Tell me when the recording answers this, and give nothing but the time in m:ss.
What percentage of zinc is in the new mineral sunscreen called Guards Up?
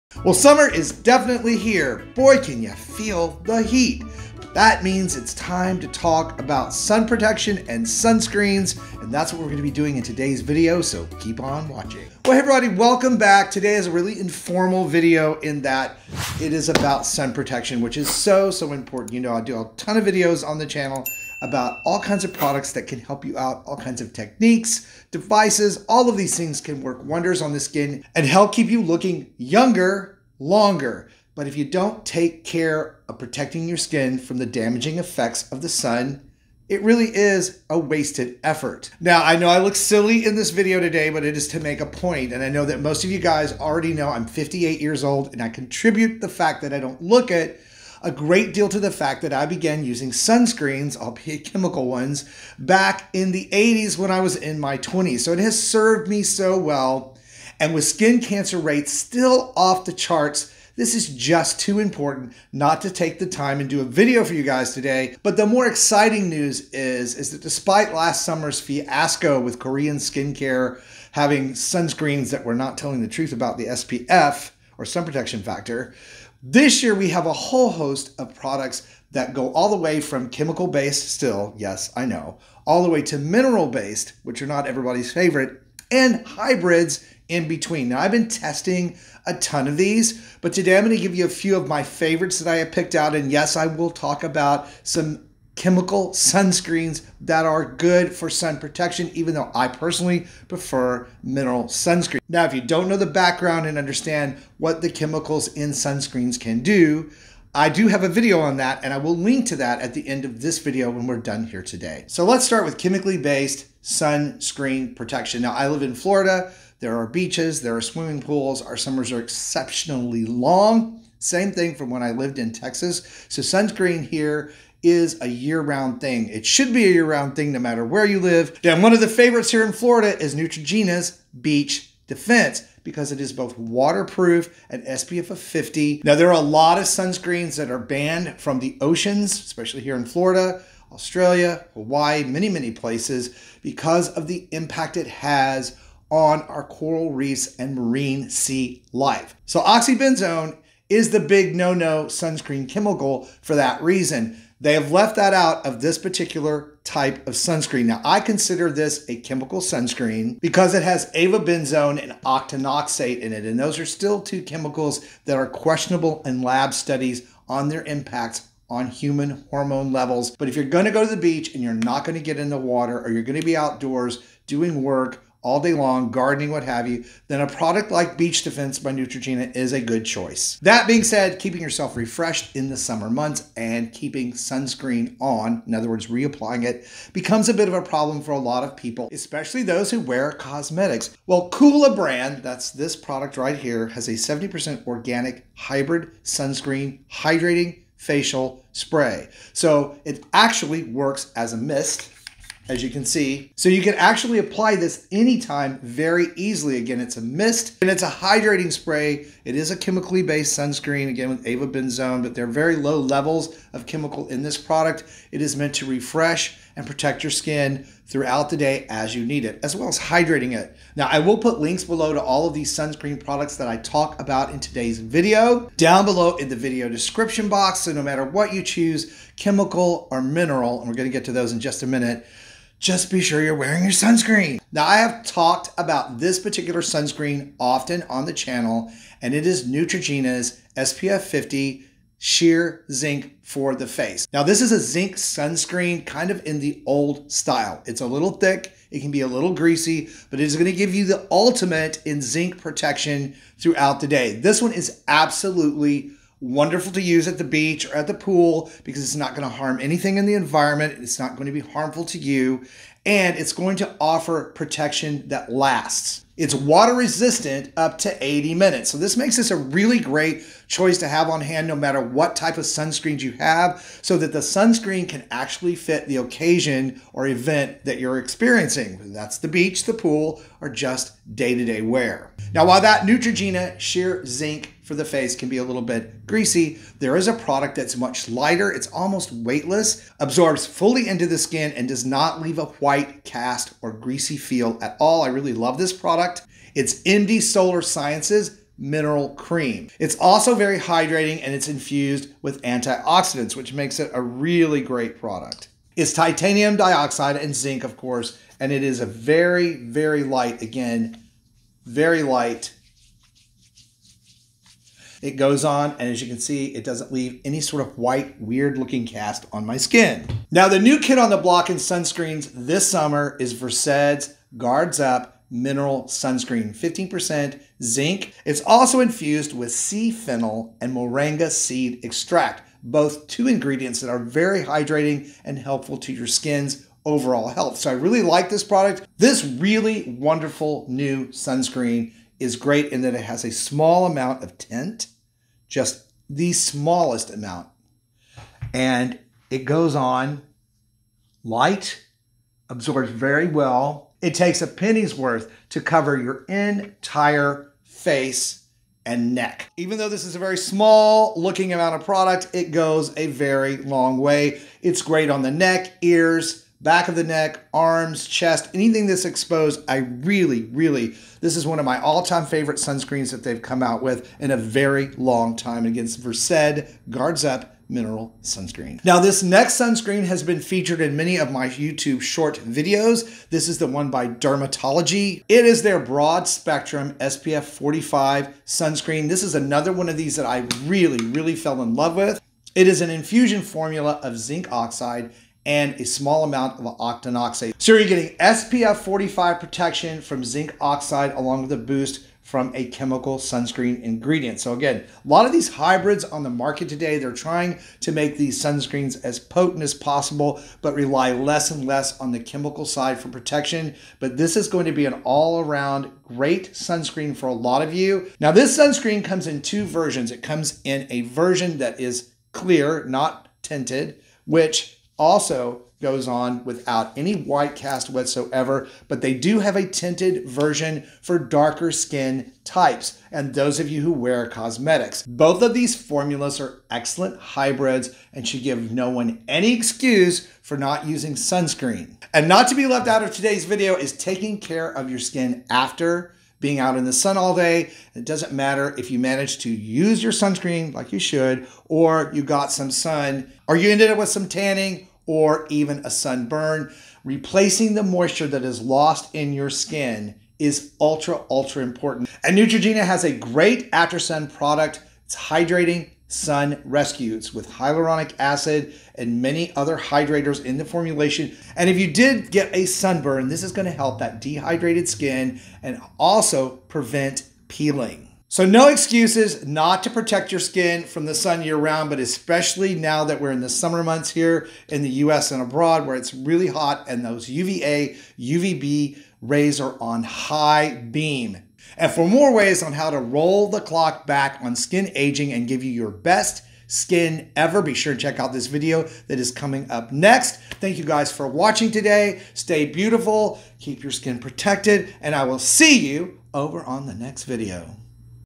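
5:26.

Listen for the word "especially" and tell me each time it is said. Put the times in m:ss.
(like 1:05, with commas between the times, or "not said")
2:19, 3:09, 8:02.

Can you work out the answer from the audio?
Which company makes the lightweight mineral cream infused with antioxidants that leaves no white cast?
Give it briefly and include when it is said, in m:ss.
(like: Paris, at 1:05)
MD Solar Sciences, at 4:57.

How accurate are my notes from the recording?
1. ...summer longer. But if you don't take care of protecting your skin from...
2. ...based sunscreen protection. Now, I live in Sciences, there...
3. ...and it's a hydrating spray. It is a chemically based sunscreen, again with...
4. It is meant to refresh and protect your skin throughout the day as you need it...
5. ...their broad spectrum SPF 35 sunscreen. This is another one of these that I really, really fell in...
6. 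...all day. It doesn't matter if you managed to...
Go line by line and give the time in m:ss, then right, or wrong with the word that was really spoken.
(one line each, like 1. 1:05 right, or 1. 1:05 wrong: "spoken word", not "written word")
1. 0:29 wrong: "younger", not "summer"
2. 1:53 wrong: "Florida", not "Sciences"
3. 3:27 right
4. 3:35 right
5. 6:25 wrong: "45", not "35"
6. 7:27 right.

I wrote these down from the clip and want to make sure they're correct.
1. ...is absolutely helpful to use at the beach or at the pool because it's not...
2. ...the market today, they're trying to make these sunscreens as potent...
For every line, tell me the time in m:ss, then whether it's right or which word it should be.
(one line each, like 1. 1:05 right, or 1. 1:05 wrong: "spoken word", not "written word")
1. 4:14 wrong: "wonderful", not "helpful"
2. 6:46 right.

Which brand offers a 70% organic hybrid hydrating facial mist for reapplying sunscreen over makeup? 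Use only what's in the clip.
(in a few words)
Coola.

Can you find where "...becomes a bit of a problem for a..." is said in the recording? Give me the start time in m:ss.
3:07.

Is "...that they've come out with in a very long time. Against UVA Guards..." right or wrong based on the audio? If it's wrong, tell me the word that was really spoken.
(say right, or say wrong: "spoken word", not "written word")
wrong: "Versed", not "UVA".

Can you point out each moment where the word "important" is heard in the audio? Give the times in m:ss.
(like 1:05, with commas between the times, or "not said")
0:18, 1:01, 7:41.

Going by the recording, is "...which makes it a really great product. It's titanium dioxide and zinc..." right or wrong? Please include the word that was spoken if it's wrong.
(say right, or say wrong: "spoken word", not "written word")
right.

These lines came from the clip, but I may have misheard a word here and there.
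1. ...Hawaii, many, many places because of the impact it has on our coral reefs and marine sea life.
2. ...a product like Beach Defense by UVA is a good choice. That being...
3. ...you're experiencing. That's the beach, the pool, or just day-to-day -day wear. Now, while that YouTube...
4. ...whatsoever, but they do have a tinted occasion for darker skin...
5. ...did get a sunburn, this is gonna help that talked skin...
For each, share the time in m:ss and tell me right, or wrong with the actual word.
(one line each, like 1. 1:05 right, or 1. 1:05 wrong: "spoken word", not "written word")
1. 2:21 right
2. 2:57 wrong: "Neutrogena", not "UVA"
3. 4:37 wrong: "Neutrogena", not "YouTube"
4. 7:08 wrong: "version", not "occasion"
5. 7:52 wrong: "dehydrated", not "talked".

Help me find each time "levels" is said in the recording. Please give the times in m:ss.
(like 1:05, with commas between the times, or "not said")
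2:49, 3:33.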